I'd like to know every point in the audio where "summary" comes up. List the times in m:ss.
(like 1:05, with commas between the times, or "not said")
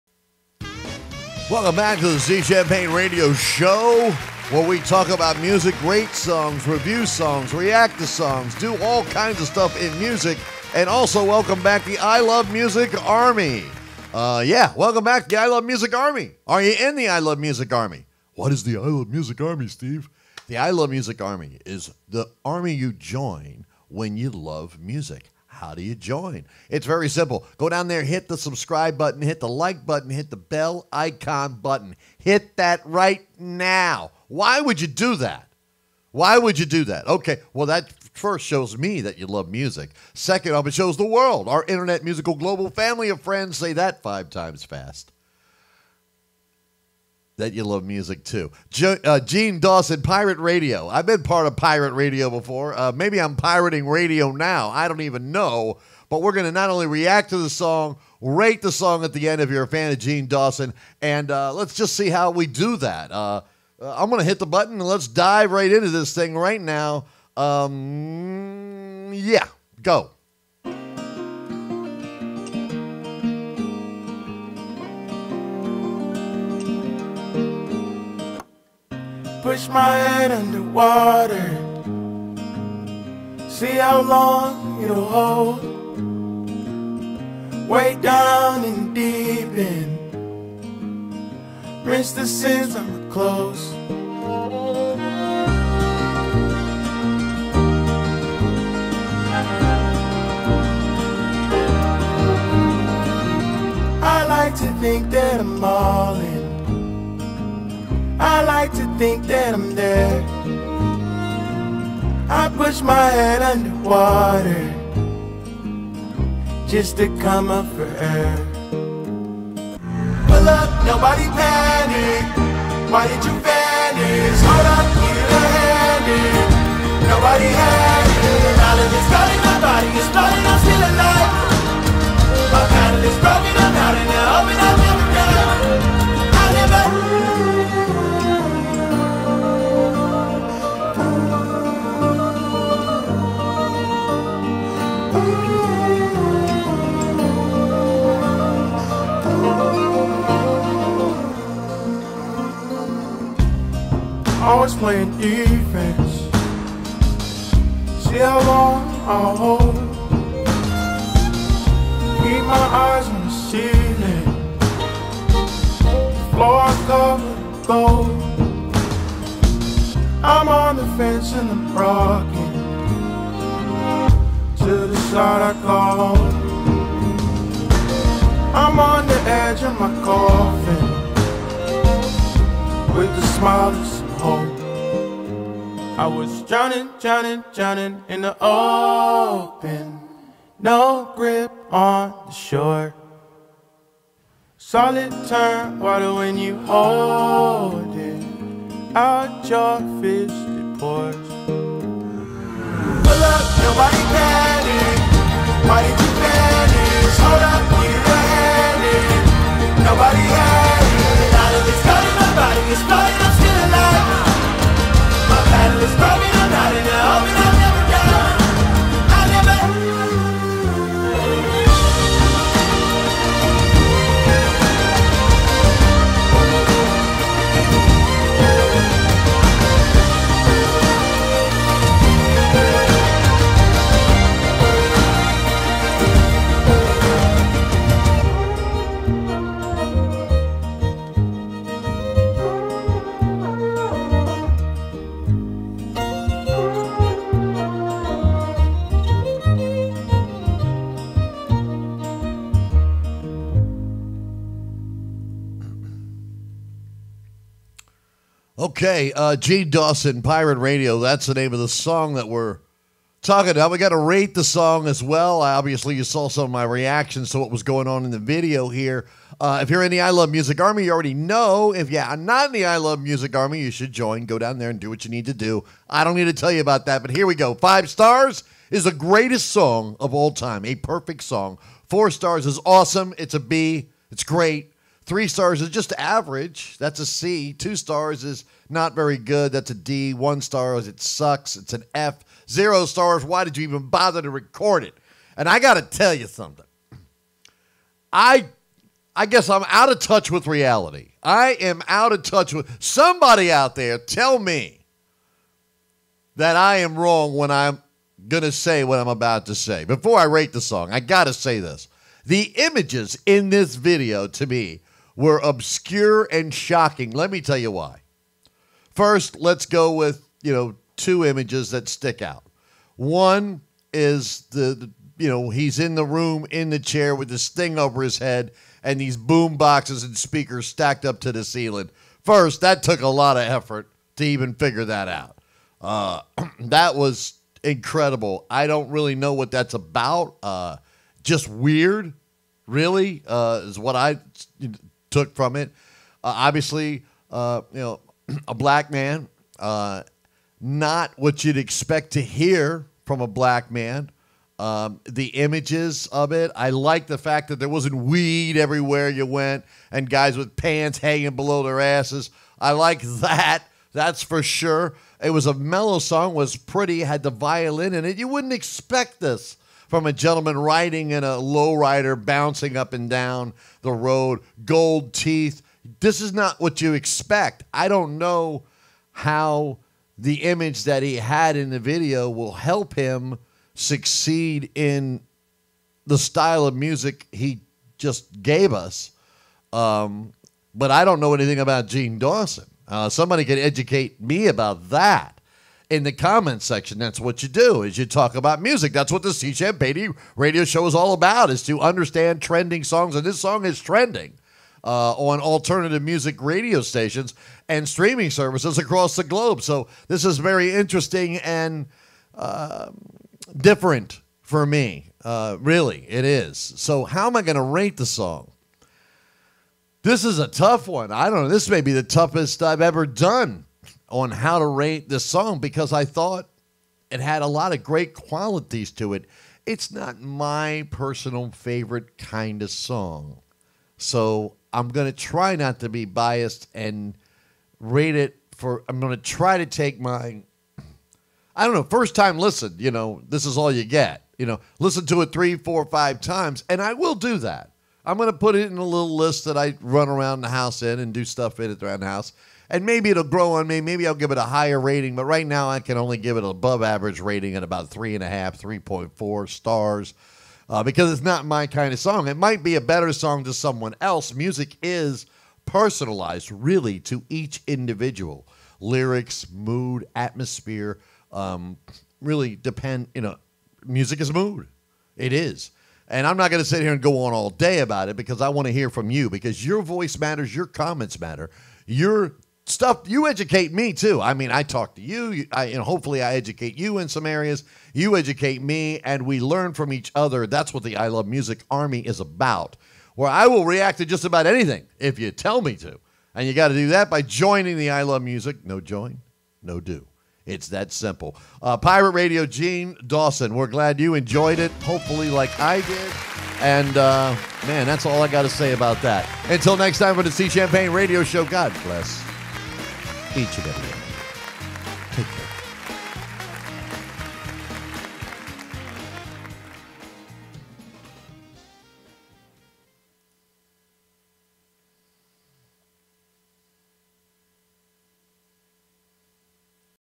not said.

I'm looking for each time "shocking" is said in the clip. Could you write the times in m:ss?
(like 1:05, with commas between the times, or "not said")
5:16.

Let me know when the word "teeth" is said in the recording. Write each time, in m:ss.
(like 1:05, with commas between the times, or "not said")
6:15.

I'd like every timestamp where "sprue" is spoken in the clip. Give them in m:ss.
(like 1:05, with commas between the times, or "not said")
not said.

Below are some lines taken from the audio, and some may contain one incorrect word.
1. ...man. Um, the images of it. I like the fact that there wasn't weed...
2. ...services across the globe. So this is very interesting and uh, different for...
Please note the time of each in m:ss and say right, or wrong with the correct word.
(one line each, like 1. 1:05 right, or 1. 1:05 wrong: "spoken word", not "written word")
1. 5:53 right
2. 6:48 right.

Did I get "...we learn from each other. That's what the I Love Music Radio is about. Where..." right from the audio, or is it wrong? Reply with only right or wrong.
wrong.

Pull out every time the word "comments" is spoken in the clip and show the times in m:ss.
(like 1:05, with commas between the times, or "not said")
6:36, 8:00.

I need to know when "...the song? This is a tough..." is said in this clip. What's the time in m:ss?
6:57.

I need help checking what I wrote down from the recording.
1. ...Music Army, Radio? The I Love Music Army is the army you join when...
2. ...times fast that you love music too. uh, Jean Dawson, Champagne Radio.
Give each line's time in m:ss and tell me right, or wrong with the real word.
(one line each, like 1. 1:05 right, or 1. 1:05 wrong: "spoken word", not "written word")
1. 0:19 wrong: "Steve", not "Radio"
2. 0:44 wrong: "Pirate", not "Champagne".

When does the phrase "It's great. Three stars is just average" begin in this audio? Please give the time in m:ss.
4:44.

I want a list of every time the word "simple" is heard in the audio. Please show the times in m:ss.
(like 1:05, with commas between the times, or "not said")
0:27, 8:20.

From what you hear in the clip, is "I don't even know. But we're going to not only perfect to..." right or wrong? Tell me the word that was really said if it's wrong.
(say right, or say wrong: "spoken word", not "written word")
wrong: "react", not "perfect".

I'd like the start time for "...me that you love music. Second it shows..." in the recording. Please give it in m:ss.
0:38.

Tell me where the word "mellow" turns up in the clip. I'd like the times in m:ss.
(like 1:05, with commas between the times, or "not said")
6:05.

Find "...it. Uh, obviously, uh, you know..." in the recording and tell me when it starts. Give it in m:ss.
5:45.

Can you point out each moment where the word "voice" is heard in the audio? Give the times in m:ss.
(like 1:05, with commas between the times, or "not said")
7:59.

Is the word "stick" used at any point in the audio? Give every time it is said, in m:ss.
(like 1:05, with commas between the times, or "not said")
5:21.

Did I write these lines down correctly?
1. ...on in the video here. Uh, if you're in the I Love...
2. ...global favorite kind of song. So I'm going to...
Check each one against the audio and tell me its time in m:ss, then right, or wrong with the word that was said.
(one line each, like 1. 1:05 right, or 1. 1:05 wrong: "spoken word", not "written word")
1. 4:27 right
2. 7:10 wrong: "personal", not "global".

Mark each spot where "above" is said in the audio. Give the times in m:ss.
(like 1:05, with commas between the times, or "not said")
7:36.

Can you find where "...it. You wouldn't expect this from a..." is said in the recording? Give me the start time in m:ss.
6:08.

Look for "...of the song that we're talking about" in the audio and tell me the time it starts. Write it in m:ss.
4:21.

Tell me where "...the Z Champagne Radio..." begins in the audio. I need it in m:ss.
0:02.